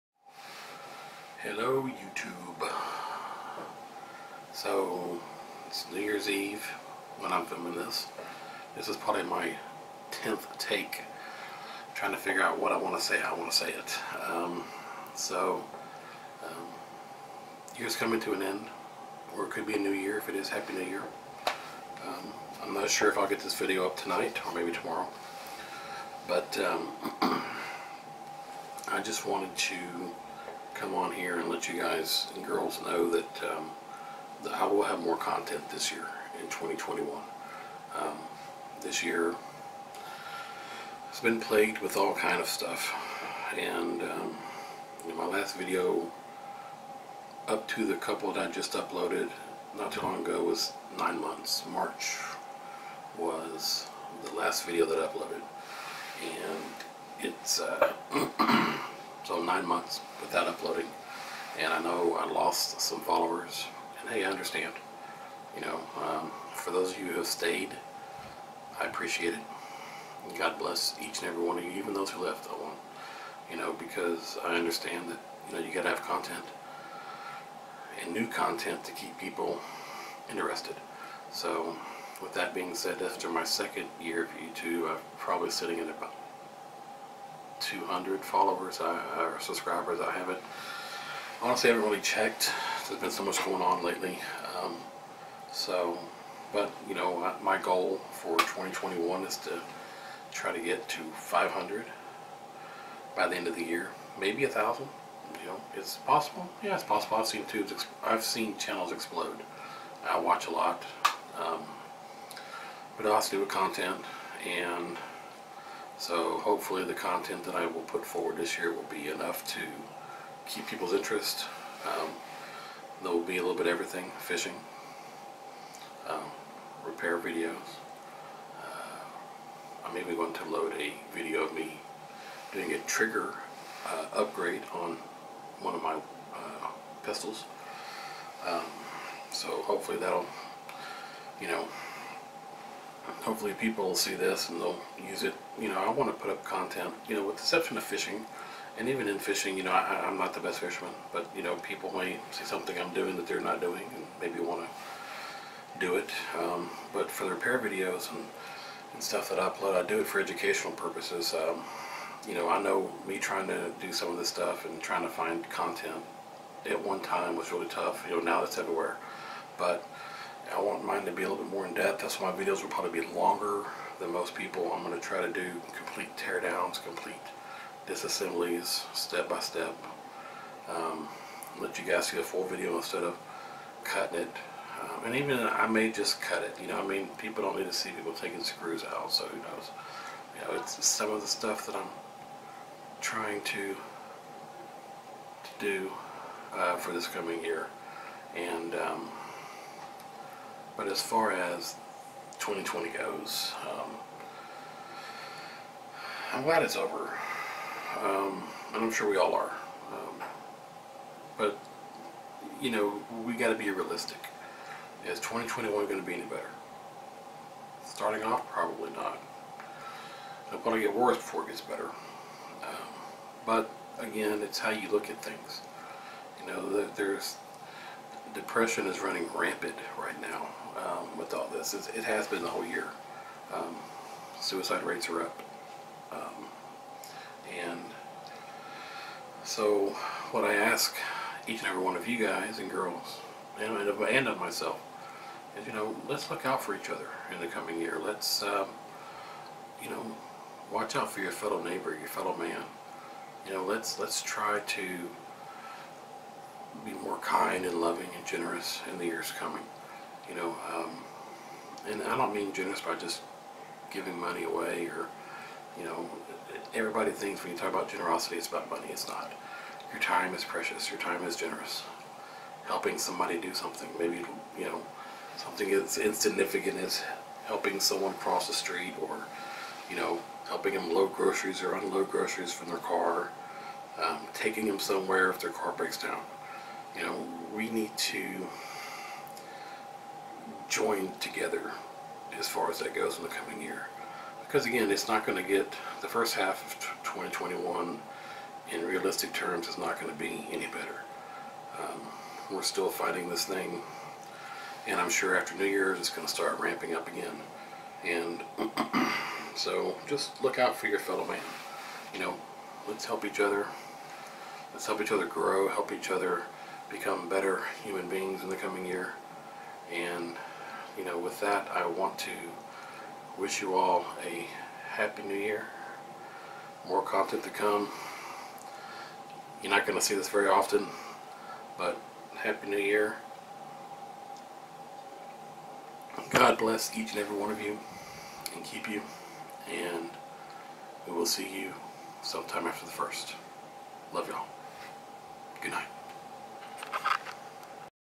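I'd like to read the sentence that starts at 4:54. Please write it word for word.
Because again, it's not going to get the first half of 2021 in realistic terms is not going to be any better.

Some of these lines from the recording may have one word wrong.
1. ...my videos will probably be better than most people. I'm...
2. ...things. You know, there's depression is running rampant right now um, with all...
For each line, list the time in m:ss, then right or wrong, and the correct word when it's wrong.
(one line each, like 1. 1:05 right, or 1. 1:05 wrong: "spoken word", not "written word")
1. 2:52 wrong: "longer", not "better"
2. 3:45 right.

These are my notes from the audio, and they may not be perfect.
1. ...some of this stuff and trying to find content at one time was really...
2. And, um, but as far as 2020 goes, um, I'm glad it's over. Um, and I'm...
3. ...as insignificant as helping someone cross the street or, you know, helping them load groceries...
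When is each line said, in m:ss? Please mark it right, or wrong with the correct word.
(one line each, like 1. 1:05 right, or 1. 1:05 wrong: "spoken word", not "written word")
1. 2:43 right
2. 3:18 right
3. 4:35 right.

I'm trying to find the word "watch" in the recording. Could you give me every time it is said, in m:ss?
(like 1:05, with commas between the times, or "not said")
1:50, 4:10.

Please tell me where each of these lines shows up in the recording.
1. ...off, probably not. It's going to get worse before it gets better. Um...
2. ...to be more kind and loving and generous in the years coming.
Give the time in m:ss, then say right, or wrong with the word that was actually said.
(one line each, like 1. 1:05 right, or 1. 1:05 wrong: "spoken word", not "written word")
1. 3:38 right
2. 4:14 right.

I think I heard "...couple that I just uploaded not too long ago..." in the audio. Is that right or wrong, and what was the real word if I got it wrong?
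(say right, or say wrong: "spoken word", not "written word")
right.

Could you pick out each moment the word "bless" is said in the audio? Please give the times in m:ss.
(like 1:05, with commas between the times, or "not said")
1:10, 5:36.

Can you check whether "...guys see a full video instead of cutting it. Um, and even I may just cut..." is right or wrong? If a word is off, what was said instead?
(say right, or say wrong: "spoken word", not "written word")
right.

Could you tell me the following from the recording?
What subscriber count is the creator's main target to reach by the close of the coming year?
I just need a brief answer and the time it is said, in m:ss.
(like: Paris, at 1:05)
500, at 1:41.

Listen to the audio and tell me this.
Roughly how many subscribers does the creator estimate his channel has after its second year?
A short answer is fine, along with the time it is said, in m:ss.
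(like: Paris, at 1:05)
200, at 1:27.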